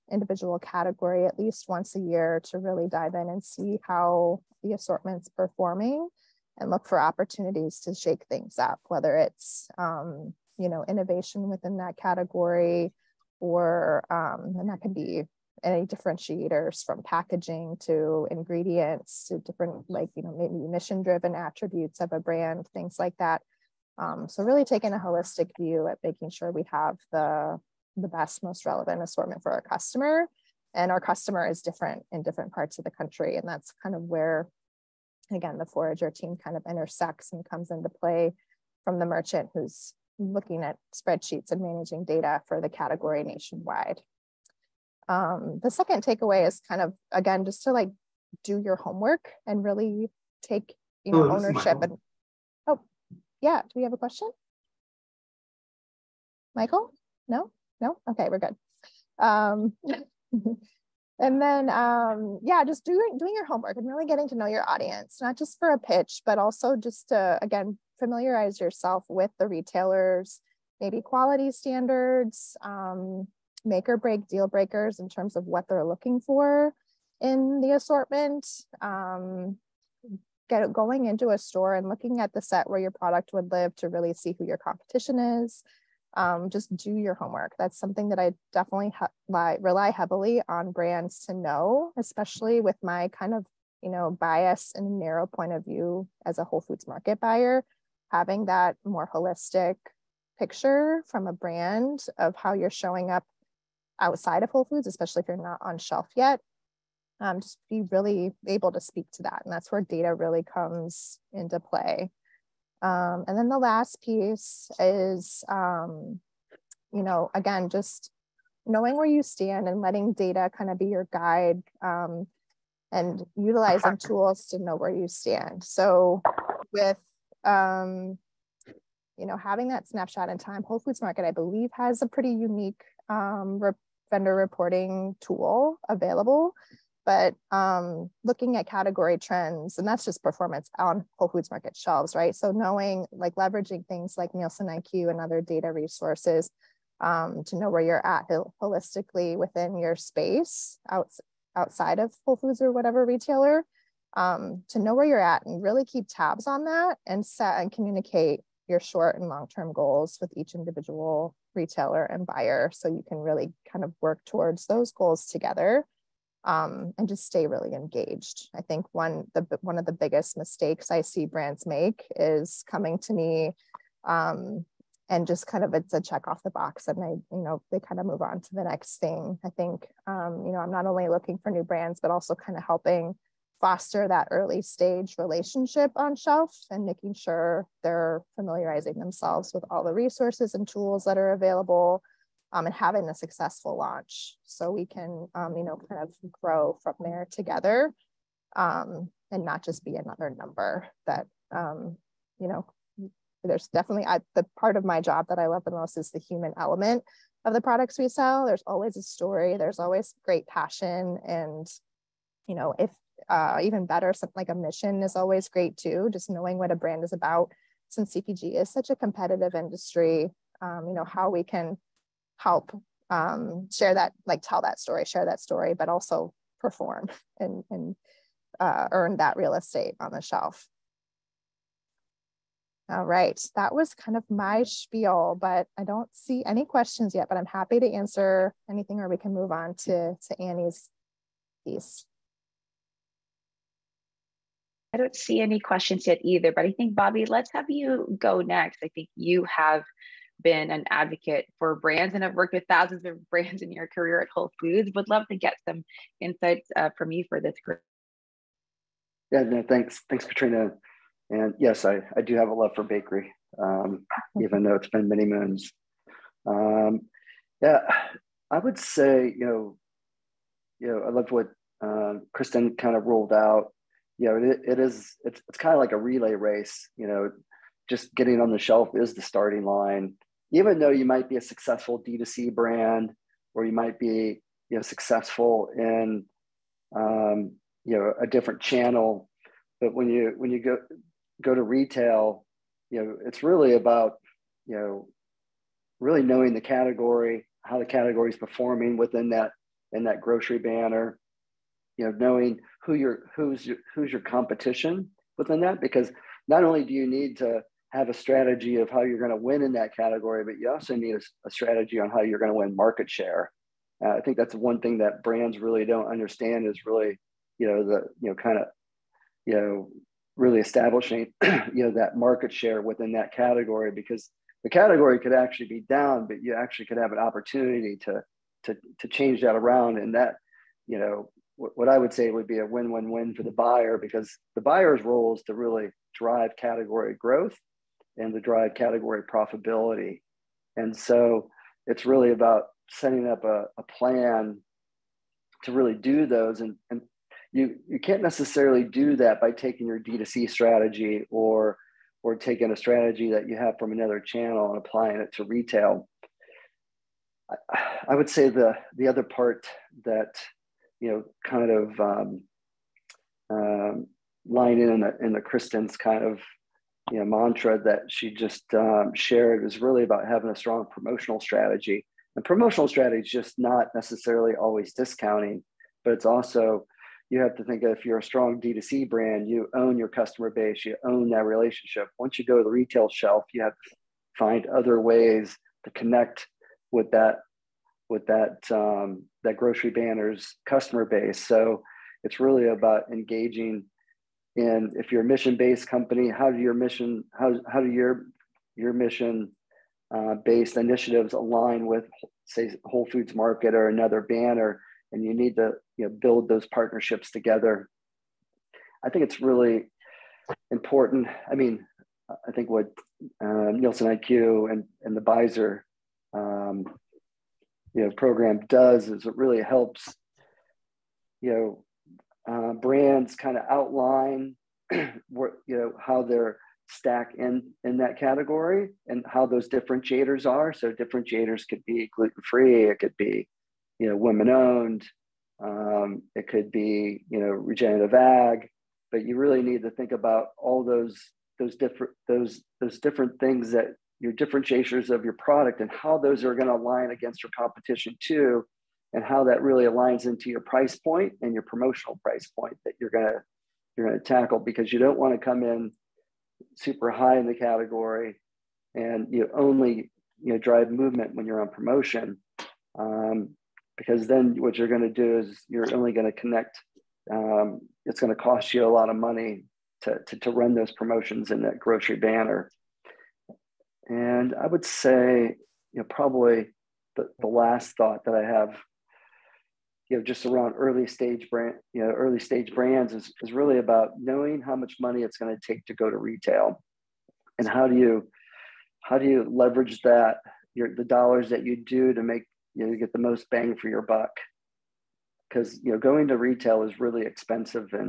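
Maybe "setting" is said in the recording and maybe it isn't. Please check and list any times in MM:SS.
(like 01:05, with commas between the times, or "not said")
05:42.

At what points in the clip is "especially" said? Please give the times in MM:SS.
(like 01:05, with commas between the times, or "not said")
01:31, 01:44.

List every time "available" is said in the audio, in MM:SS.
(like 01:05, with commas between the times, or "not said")
02:15, 03:11.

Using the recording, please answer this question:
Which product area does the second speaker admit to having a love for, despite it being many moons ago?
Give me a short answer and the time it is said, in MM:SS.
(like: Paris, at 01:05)
Bakery, at 04:22.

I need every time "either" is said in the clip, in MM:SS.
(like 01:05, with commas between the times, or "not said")
04:06.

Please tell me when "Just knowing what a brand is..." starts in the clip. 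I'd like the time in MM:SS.
03:36.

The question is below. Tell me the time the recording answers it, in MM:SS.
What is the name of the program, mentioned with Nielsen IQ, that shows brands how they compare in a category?
06:55.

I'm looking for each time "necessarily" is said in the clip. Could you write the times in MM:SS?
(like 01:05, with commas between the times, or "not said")
05:48, 06:13.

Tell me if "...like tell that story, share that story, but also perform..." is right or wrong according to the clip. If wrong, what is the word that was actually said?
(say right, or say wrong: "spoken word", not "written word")
right.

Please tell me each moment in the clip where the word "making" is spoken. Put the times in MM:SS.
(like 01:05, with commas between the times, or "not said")
00:26, 03:06.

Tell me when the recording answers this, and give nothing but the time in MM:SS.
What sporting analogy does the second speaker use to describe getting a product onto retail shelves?
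04:35.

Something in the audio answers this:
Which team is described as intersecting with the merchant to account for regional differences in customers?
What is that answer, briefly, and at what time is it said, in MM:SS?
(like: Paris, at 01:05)
Forager team, at 00:35.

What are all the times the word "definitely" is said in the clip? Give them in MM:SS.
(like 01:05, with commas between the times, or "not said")
01:28, 03:23.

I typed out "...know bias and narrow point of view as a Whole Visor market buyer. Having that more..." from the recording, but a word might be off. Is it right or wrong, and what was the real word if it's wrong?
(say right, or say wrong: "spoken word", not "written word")
wrong: "Foods", not "Visor".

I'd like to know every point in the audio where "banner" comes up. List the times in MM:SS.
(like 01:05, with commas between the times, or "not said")
05:00, 06:29, 06:44, 07:52.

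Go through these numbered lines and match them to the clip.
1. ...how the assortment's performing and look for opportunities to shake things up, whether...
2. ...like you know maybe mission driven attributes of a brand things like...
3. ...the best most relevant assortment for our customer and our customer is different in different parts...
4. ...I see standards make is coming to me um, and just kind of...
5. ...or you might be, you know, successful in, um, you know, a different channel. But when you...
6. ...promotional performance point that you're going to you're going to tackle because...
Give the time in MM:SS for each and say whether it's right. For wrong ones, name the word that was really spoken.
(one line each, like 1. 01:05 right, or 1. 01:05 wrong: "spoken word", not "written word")
1. 00:03 right
2. 00:19 right
3. 00:27 right
4. 02:50 wrong: "brands", not "standards"
5. 04:43 right
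6. 07:31 wrong: "price", not "performance".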